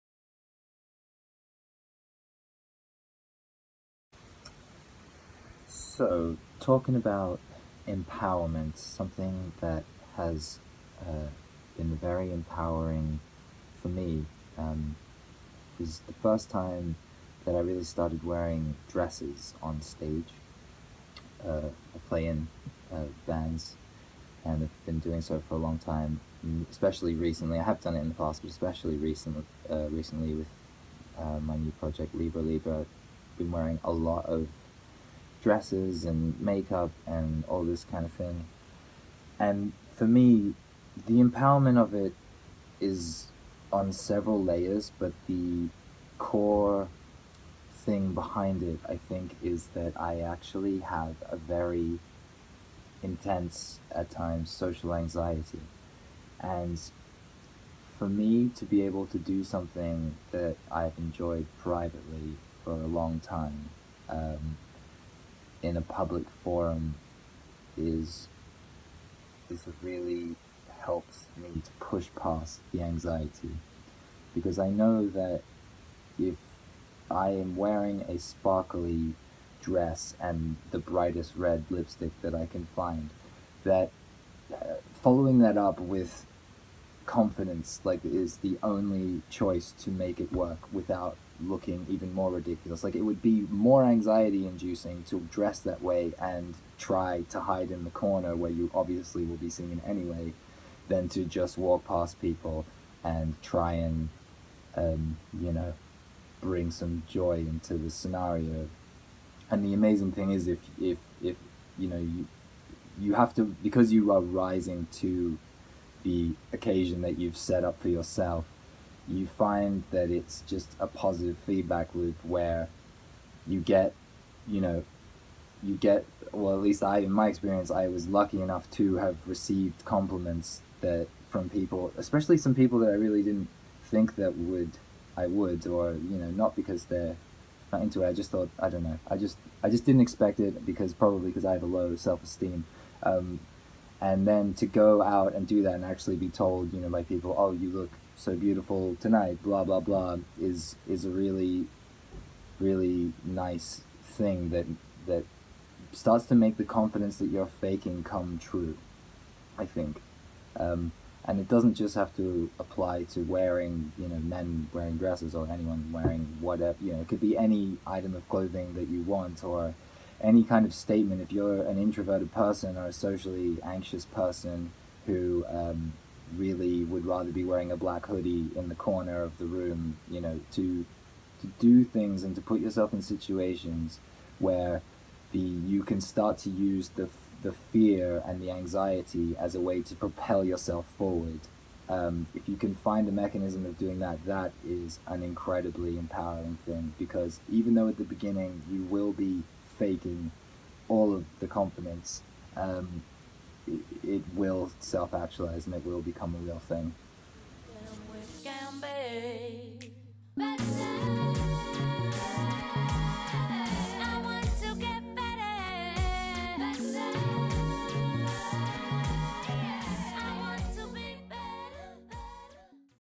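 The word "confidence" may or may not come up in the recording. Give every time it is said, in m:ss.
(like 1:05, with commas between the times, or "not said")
1:27, 2:36, 3:21.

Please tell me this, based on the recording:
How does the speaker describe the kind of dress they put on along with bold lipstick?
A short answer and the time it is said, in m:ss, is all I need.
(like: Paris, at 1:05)
sparkly, at 1:18.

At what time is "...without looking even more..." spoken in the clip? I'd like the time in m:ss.
1:30.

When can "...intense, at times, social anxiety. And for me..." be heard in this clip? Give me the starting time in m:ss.
0:53.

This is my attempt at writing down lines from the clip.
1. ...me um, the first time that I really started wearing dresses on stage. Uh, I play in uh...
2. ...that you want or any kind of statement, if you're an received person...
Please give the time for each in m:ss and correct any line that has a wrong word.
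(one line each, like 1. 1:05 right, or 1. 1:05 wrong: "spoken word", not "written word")
1. 0:13 right
2. 2:48 wrong: "introverted", not "received".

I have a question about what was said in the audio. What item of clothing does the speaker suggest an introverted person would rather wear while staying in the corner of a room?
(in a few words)
black hoodie.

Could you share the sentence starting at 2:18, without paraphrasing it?
I just thought, I don't know.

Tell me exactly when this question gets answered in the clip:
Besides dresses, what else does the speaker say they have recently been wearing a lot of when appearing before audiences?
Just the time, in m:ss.
0:36.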